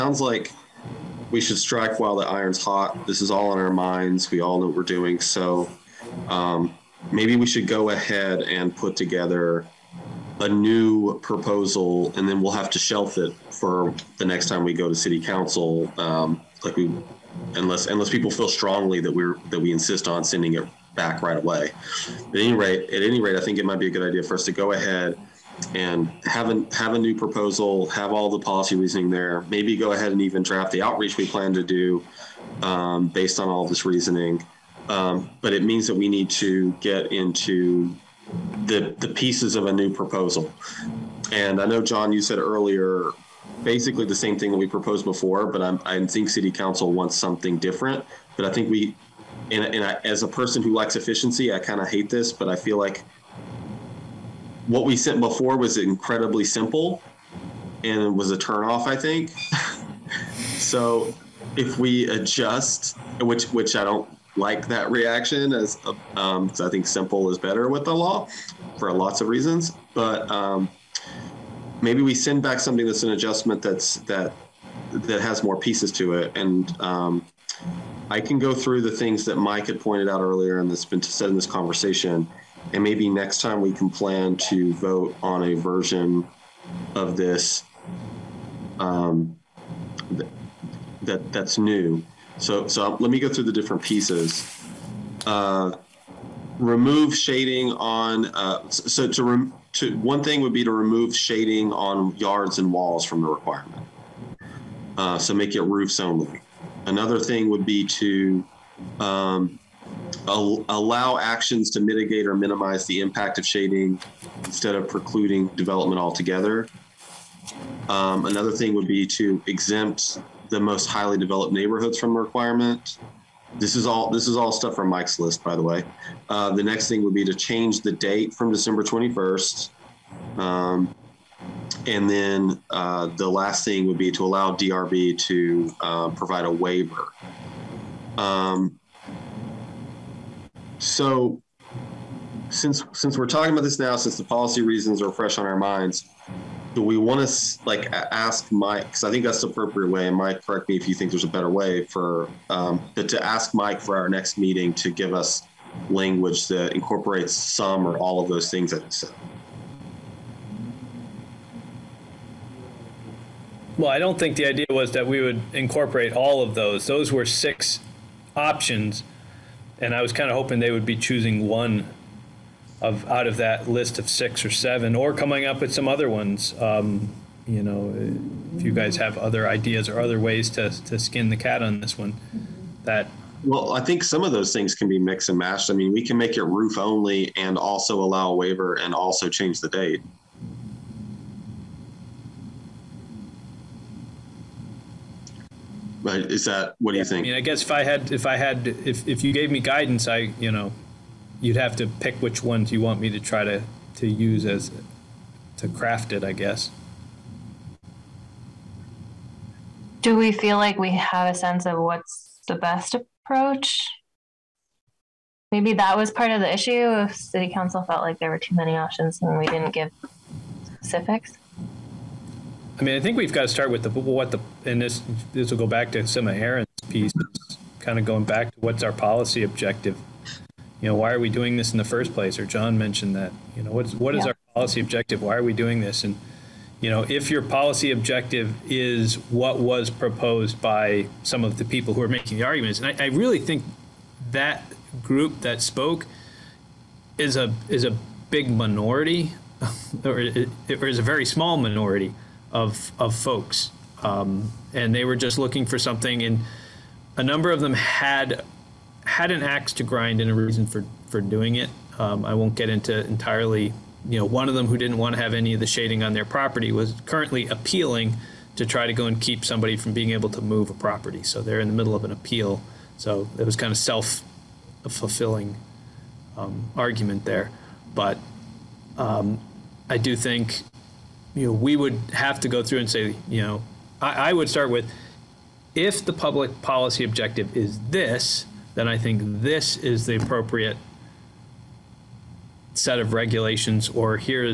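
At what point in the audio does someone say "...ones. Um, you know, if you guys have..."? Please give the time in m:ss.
2:56.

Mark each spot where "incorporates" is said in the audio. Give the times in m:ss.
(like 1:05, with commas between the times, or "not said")
2:36, 2:45.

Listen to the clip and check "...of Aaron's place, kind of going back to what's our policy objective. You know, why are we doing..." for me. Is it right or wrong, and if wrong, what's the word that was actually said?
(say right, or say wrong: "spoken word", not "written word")
wrong: "piece", not "place".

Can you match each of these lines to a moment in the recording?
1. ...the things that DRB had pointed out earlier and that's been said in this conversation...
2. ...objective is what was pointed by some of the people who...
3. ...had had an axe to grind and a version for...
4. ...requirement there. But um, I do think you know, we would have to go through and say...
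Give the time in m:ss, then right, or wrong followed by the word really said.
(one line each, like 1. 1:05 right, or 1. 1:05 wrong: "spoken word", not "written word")
1. 1:18 wrong: "Mike", not "DRB"
2. 3:57 wrong: "proposed", not "pointed"
3. 4:17 wrong: "reason", not "version"
4. 4:36 wrong: "argument", not "requirement".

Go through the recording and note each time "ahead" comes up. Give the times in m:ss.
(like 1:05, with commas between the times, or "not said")
0:07, 0:24, 0:29.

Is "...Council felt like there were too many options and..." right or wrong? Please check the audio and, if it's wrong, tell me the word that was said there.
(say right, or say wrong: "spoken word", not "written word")
right.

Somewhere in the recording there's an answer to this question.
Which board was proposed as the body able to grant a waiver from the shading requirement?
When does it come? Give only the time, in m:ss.
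2:14.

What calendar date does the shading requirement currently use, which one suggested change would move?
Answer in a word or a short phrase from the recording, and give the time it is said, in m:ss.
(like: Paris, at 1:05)
December 21st, at 2:08.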